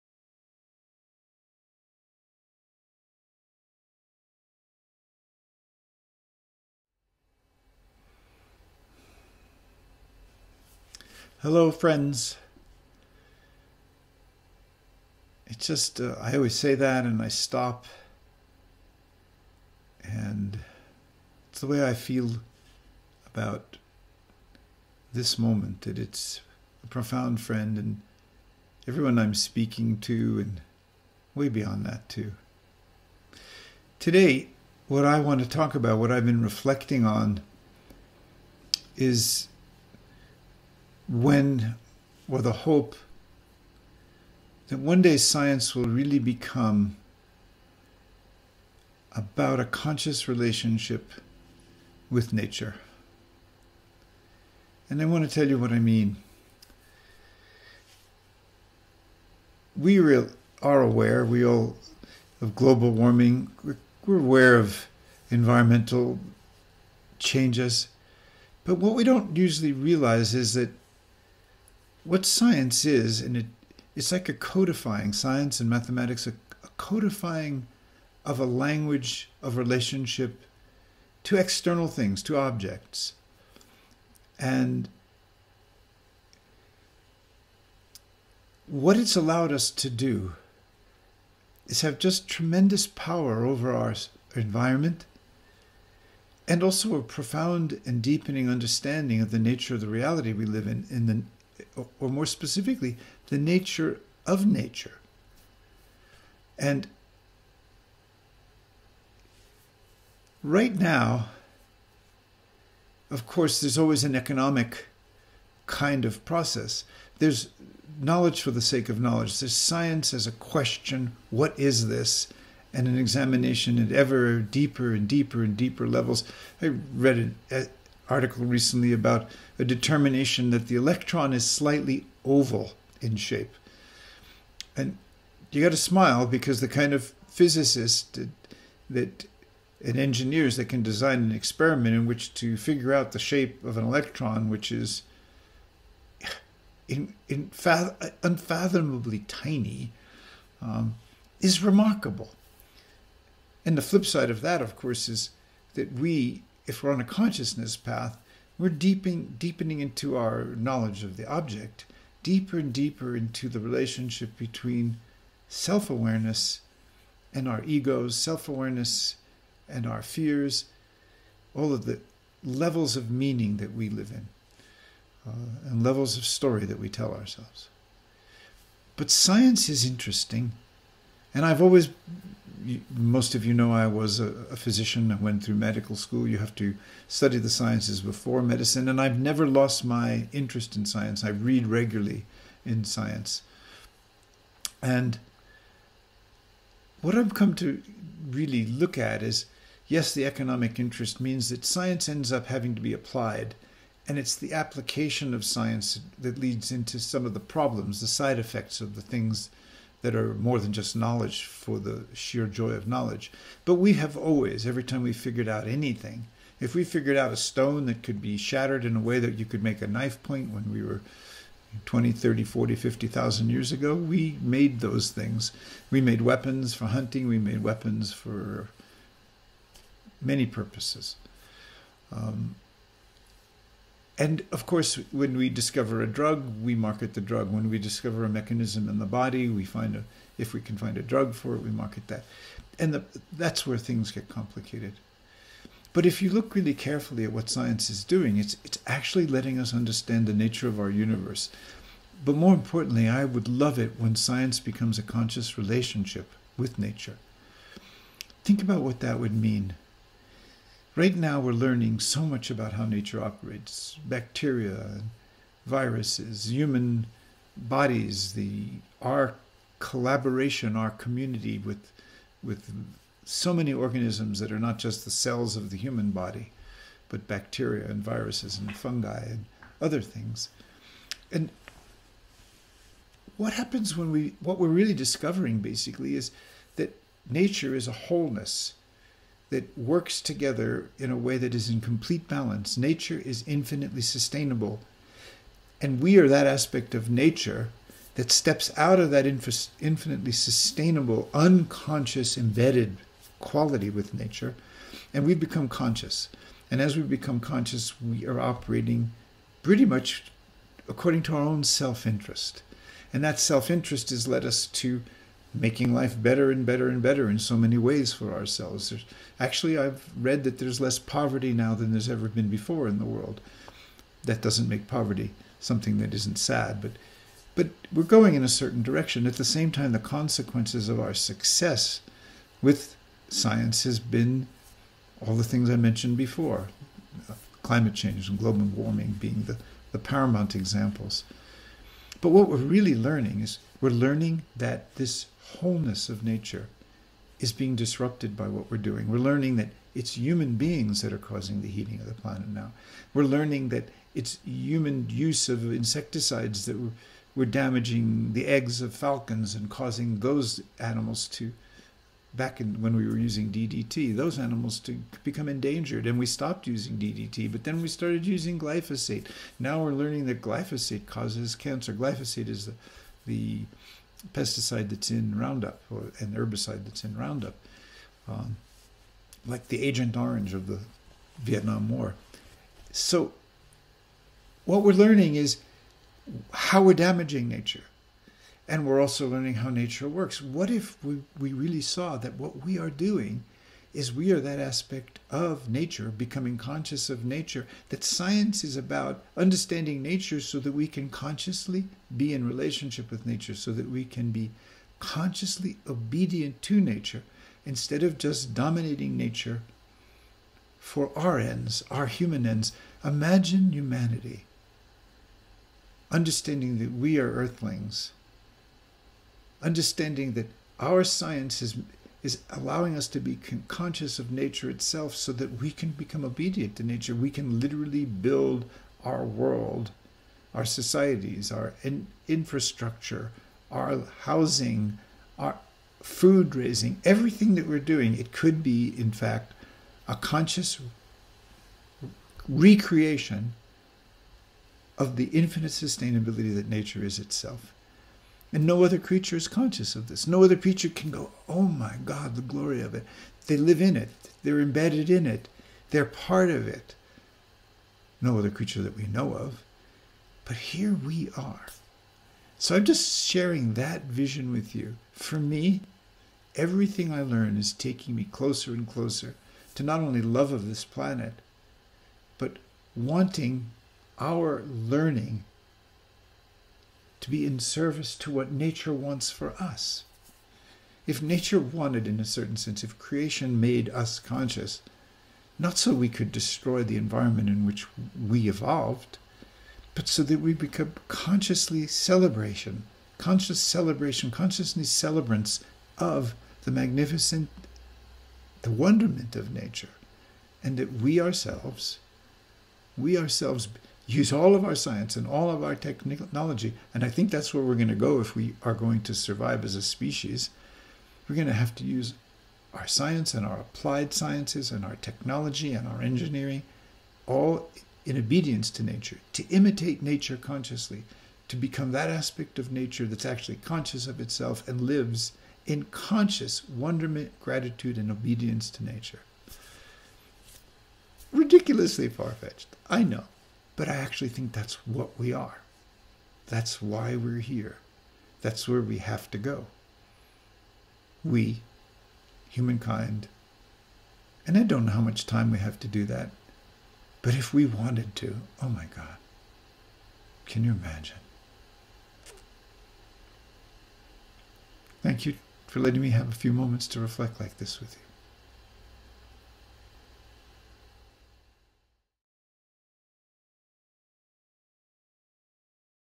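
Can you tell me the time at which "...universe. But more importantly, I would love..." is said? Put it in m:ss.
4:10.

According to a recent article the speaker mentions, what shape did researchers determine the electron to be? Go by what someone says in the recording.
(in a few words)
Slightly oval.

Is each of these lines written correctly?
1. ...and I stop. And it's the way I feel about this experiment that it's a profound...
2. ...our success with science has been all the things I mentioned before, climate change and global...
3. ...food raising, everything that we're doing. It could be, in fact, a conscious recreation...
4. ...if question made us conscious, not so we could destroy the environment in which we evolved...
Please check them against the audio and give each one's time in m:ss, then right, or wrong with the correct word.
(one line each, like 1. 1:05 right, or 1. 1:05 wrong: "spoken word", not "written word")
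1. 0:17 wrong: "moment", not "experiment"
2. 5:31 right
3. 7:16 right
4. 8:02 wrong: "creation", not "question".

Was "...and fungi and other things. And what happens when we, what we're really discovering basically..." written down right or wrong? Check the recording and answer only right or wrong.
right.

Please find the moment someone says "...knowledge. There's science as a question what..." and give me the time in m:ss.
1:59.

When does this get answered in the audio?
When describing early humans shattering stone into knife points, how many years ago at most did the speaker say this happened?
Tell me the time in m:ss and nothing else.
3:42.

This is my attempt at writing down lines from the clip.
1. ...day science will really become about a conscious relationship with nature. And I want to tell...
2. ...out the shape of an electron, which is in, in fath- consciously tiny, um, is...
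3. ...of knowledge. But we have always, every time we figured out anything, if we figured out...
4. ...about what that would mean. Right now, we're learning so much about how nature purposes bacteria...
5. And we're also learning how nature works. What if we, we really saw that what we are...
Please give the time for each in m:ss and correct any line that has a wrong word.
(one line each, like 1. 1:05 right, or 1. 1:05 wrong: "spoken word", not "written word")
1. 0:45 right
2. 2:22 wrong: "unfathomably", not "consciously"
3. 3:32 right
4. 4:18 wrong: "operates", not "purposes"
5. 6:28 right.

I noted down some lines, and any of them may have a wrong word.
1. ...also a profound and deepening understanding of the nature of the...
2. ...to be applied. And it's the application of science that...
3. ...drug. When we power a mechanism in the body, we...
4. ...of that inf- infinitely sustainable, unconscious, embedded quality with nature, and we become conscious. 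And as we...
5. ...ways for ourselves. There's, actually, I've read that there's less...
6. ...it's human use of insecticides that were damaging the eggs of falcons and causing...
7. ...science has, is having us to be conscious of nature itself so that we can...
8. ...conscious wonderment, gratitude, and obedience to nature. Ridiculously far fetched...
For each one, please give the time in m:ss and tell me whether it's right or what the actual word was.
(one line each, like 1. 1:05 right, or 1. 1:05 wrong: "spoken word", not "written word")
1. 1:36 right
2. 3:22 right
3. 3:57 wrong: "discover", not "power"
4. 4:58 right
5. 5:17 right
6. 5:54 right
7. 7:01 wrong: "allowing", not "having"
8. 8:45 right.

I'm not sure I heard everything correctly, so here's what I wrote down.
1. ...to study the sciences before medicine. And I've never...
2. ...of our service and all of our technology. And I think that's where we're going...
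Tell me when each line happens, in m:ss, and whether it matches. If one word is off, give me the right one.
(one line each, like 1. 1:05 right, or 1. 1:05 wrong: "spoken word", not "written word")
1. 3:06 right
2. 8:24 wrong: "science", not "service".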